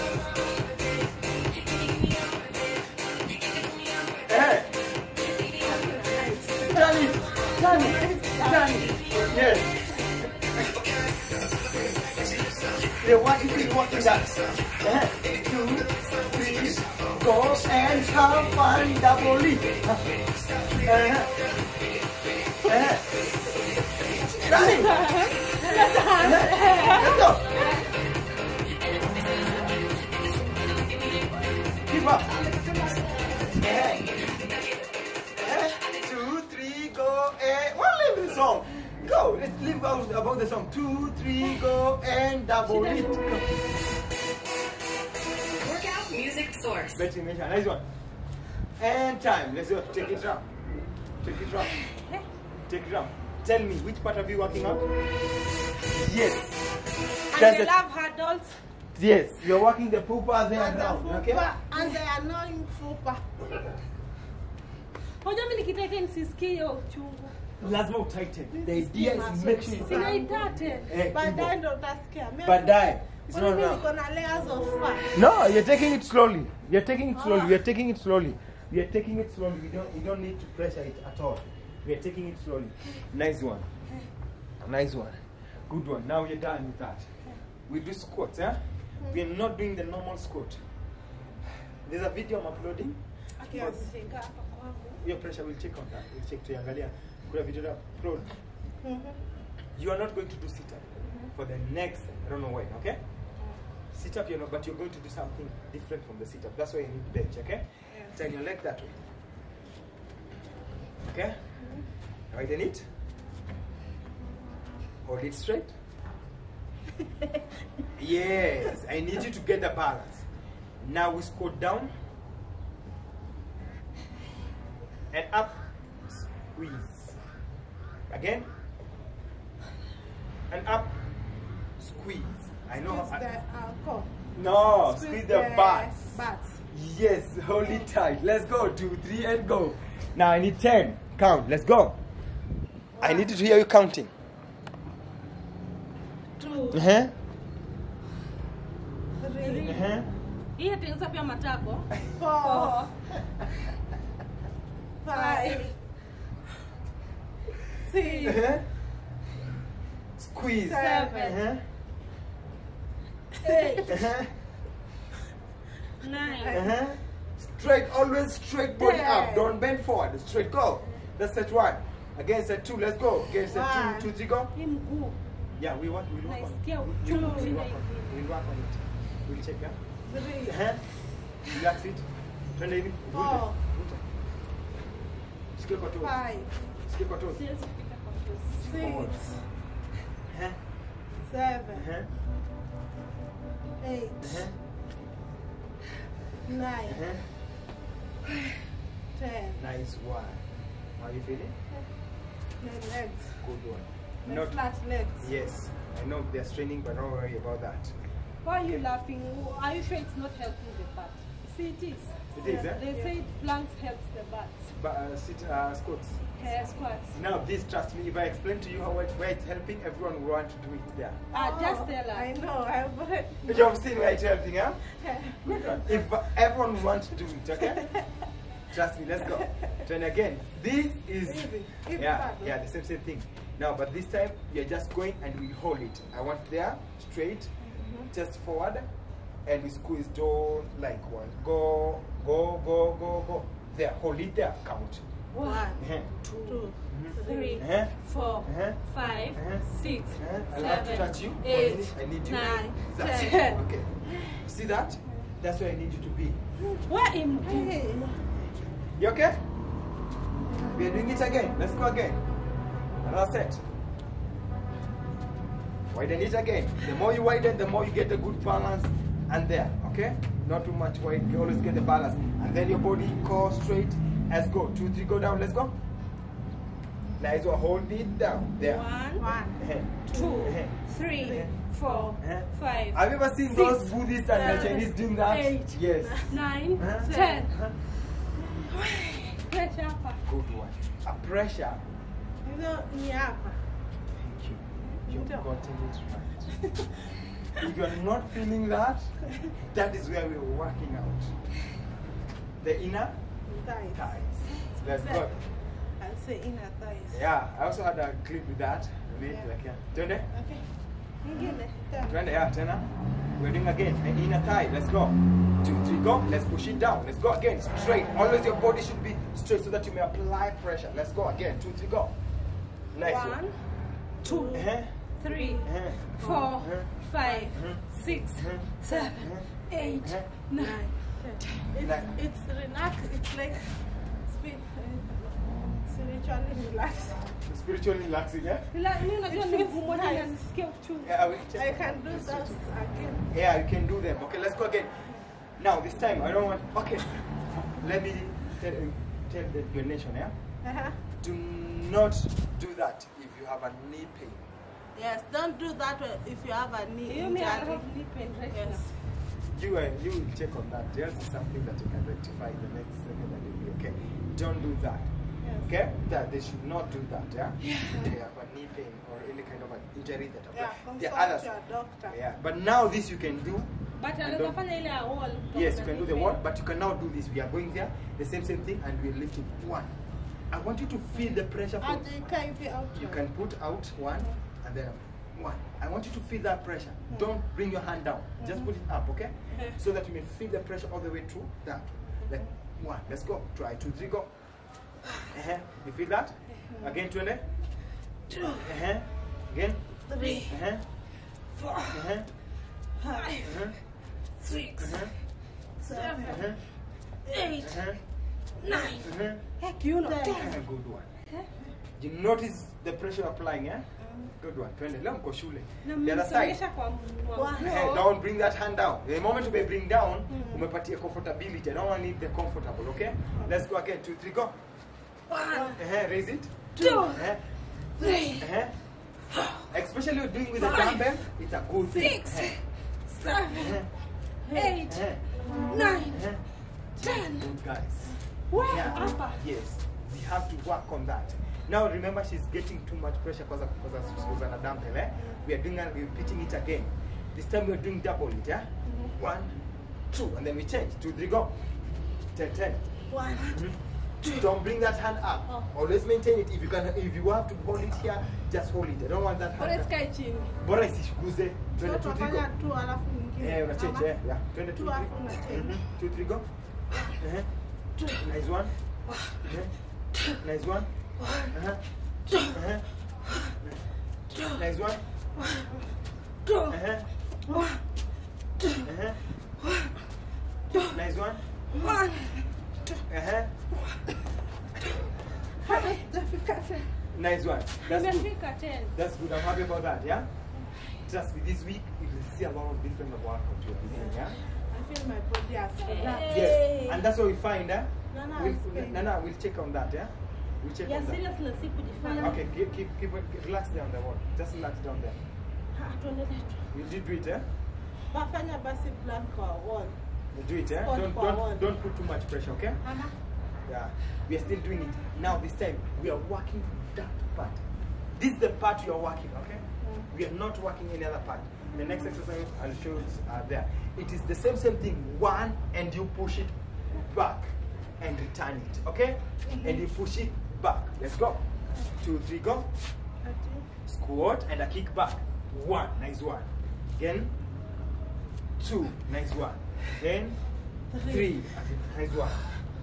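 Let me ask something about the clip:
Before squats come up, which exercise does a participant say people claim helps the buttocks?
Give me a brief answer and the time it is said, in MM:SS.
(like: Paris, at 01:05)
planks, at 03:33.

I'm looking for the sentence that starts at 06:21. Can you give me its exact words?
From, you can put out one them.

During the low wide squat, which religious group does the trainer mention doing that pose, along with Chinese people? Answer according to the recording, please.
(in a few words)
Buddhists.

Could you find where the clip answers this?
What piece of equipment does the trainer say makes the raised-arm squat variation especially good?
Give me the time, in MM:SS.
07:10.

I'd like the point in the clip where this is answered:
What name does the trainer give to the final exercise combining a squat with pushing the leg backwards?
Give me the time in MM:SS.
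08:53.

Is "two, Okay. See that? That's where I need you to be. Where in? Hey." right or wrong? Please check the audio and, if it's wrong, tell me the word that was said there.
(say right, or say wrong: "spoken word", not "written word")
right.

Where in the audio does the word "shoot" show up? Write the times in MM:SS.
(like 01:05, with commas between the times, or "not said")
not said.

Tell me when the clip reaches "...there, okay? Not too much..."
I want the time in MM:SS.
04:29.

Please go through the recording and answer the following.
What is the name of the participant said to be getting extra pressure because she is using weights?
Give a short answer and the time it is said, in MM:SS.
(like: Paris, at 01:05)
Susanna, at 07:24.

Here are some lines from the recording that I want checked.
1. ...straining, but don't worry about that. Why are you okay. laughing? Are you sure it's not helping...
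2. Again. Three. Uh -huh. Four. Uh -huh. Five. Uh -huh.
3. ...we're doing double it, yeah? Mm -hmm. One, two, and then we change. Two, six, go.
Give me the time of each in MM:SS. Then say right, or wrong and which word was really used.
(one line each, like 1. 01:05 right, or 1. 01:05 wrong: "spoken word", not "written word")
1. 03:26 right
2. 06:39 right
3. 07:27 wrong: "three", not "six".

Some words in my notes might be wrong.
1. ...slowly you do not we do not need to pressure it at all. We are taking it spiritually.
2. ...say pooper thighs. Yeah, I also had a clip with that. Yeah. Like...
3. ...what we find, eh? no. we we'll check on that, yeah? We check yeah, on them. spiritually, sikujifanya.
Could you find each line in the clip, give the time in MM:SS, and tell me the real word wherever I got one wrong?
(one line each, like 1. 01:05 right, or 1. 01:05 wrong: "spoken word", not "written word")
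1. 01:20 wrong: "slowly", not "spiritually"
2. 05:06 wrong: "inner", not "pooper"
3. 08:17 wrong: "seriously", not "spiritually".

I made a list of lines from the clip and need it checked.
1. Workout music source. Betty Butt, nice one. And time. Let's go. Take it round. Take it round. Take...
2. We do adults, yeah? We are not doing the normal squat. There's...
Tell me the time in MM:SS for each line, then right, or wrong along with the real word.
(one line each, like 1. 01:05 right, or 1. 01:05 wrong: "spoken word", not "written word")
1. 00:45 wrong: "Misha", not "Butt"
2. 01:27 wrong: "squats", not "adults".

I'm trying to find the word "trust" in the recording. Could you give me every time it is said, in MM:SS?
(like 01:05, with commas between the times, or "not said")
03:37, 03:48, 08:11.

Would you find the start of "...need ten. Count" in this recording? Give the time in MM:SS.
02:20.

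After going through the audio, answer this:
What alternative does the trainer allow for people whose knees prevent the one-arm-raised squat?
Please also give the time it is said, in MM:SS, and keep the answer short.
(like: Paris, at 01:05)
the wall, at 06:16.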